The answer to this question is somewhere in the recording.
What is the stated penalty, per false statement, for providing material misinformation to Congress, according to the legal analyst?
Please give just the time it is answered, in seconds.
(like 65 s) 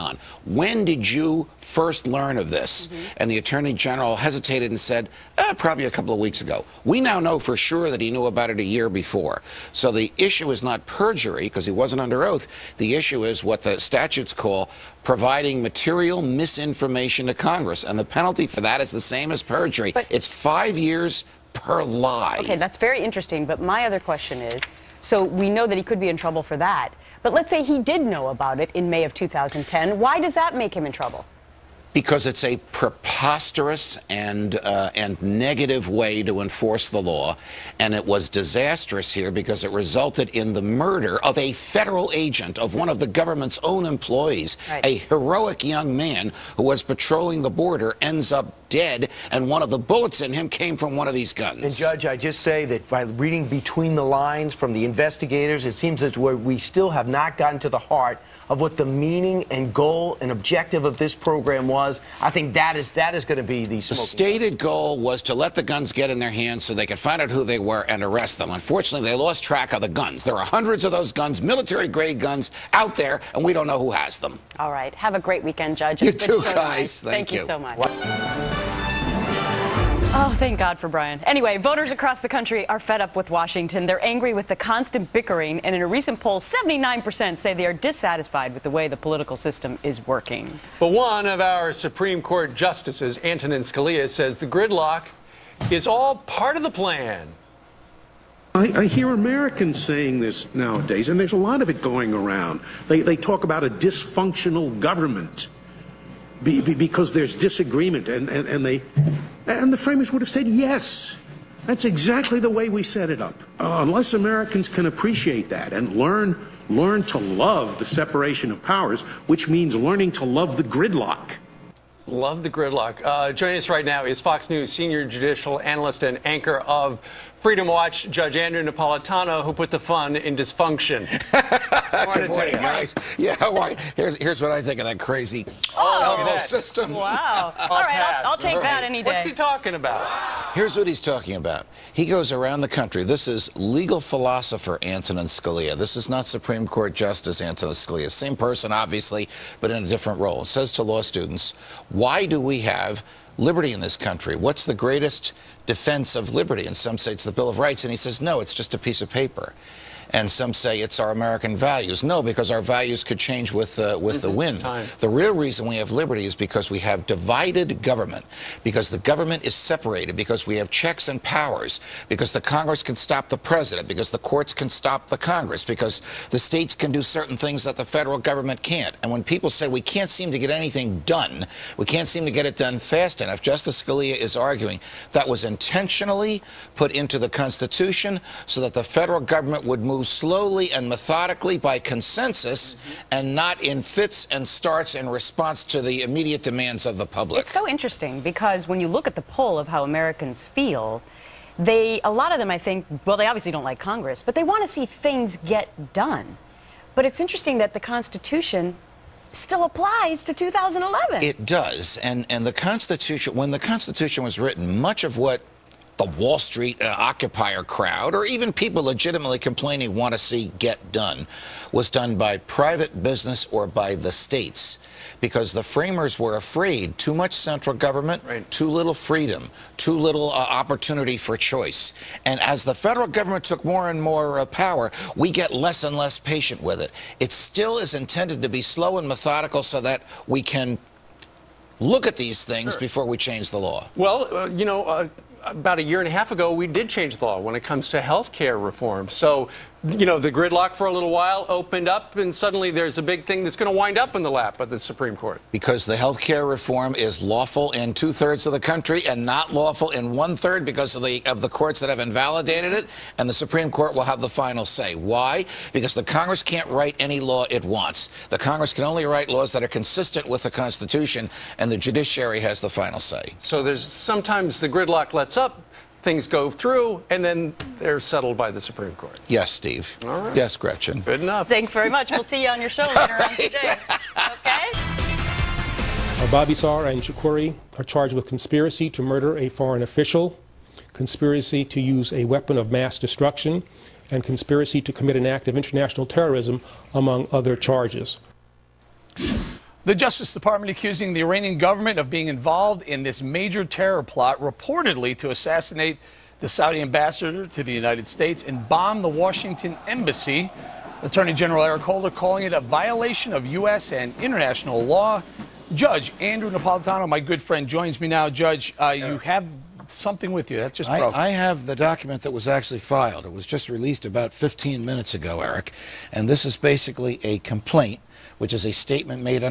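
20 s.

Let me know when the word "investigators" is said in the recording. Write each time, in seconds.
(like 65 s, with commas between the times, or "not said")
54 s.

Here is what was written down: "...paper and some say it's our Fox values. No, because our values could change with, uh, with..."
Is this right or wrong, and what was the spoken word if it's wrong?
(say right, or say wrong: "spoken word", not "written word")
wrong: "American", not "Fox".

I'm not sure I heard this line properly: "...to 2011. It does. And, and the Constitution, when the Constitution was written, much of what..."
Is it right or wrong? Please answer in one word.
right.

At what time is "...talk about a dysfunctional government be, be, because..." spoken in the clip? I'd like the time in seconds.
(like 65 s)
103 s.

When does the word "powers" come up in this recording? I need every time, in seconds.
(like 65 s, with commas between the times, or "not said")
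118 s, 171 s, 234 s.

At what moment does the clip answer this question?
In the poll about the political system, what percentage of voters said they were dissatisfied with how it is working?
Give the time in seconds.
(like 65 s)
86 s.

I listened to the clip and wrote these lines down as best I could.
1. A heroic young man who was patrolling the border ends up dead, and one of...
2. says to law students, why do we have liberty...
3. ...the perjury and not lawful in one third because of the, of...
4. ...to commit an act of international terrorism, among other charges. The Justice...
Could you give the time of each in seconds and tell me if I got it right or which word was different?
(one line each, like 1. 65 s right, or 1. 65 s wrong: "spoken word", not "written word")
1. 44 s right
2. 150 s right
3. 258 s wrong: "country", not "perjury"
4. 294 s right.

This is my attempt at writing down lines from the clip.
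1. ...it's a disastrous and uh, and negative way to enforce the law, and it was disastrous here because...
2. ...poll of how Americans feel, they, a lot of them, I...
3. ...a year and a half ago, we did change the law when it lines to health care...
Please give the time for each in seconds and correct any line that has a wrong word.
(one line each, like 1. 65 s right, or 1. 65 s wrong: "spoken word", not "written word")
1. 32 s wrong: "preposterous", not "disastrous"
2. 199 s right
3. 245 s wrong: "comes", not "lines".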